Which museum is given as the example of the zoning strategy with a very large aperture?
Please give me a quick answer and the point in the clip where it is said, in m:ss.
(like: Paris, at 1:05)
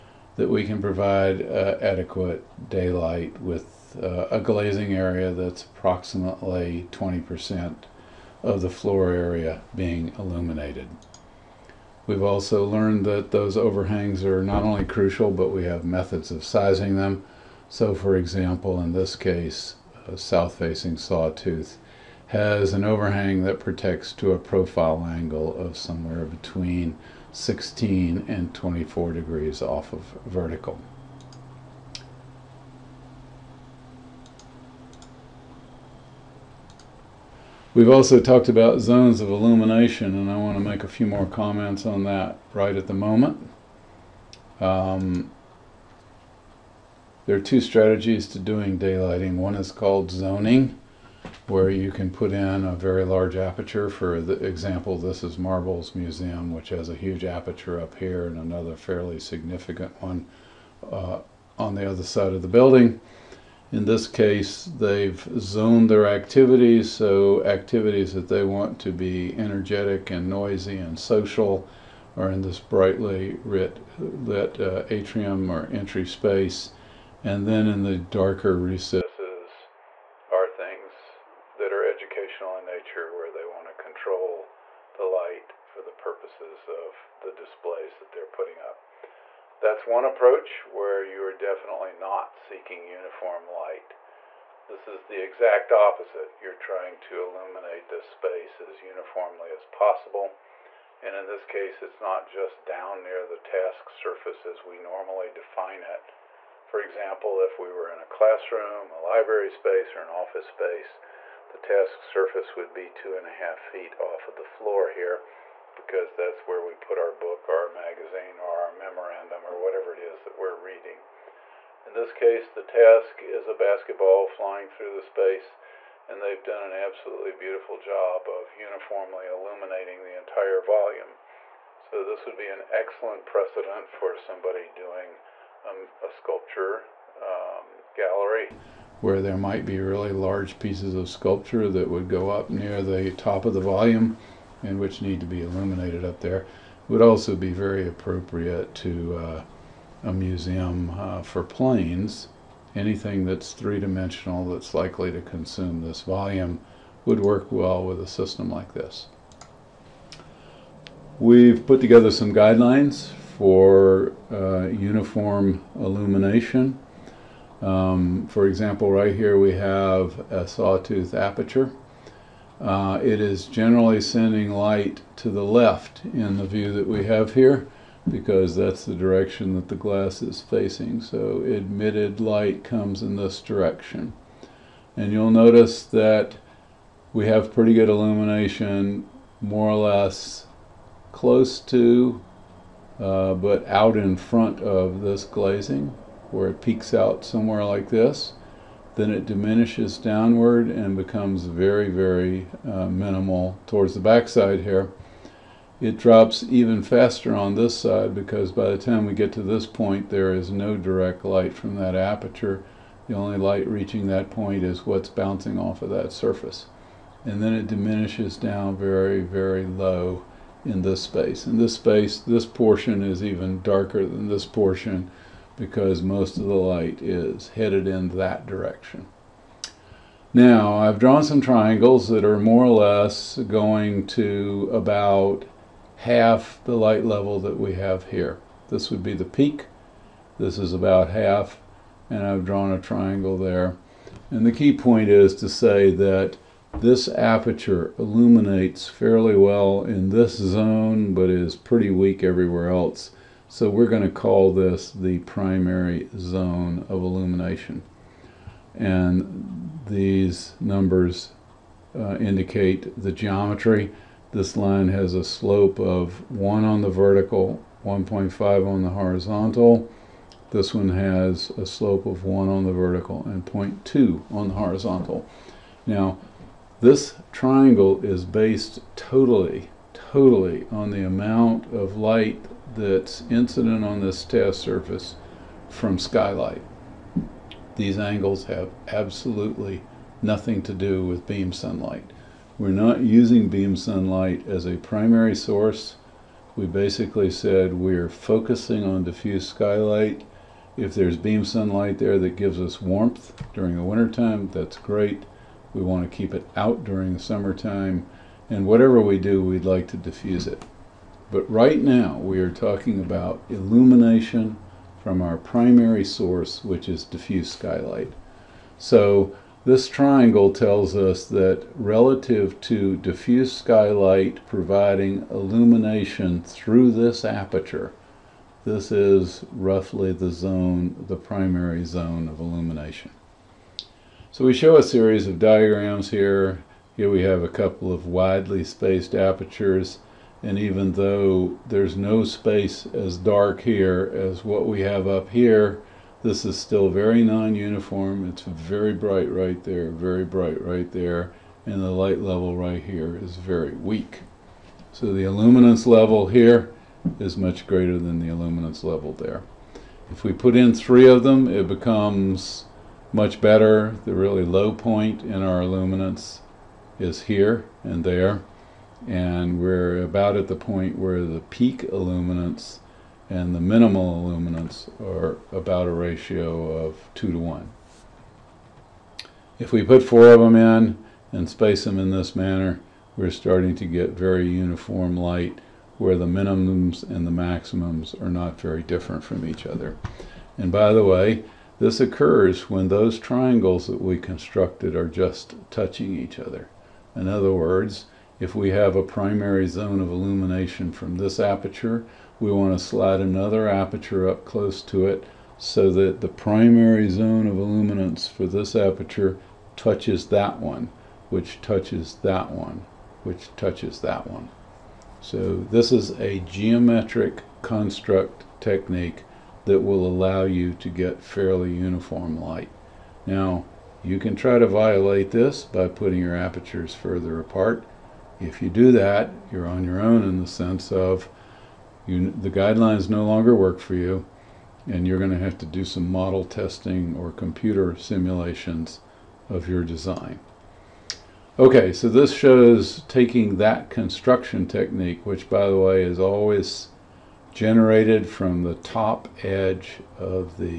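Marbles Museum, at 0:55.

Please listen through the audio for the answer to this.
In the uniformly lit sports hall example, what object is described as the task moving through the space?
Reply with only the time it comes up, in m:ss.
2:03.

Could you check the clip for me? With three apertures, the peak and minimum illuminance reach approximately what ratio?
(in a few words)
2 to 1.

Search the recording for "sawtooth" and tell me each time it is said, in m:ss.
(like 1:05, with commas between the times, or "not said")
0:20, 2:50.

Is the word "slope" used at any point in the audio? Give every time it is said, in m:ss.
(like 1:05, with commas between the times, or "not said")
4:25, 4:31.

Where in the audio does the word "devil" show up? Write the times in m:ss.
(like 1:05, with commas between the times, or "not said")
not said.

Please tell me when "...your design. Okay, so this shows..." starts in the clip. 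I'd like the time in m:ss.
7:19.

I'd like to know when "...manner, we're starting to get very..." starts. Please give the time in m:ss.
6:22.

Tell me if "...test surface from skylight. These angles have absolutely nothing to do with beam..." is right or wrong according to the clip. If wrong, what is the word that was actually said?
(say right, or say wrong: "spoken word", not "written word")
right.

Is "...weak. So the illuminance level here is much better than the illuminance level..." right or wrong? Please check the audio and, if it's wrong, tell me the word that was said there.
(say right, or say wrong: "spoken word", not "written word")
wrong: "greater", not "better".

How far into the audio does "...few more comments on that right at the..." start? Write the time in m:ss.
0:40.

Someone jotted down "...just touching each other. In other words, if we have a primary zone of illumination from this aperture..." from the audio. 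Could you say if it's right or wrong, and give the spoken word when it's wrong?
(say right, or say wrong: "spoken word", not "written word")
right.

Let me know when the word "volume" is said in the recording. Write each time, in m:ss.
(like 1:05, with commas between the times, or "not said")
2:10, 2:23, 2:36.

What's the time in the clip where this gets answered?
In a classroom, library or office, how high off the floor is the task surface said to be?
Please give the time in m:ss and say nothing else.
1:52.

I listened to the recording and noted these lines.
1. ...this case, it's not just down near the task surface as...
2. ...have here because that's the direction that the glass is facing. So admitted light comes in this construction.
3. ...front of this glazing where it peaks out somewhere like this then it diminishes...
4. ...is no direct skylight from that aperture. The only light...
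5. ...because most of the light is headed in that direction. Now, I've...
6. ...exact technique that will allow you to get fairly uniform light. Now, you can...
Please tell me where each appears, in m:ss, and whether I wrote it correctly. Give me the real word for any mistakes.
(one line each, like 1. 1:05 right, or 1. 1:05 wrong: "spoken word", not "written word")
1. 1:41 right
2. 2:57 wrong: "direction", not "construction"
3. 3:14 right
4. 3:30 wrong: "light", not "skylight"
5. 3:45 right
6. 6:57 wrong: "construct", not "exact".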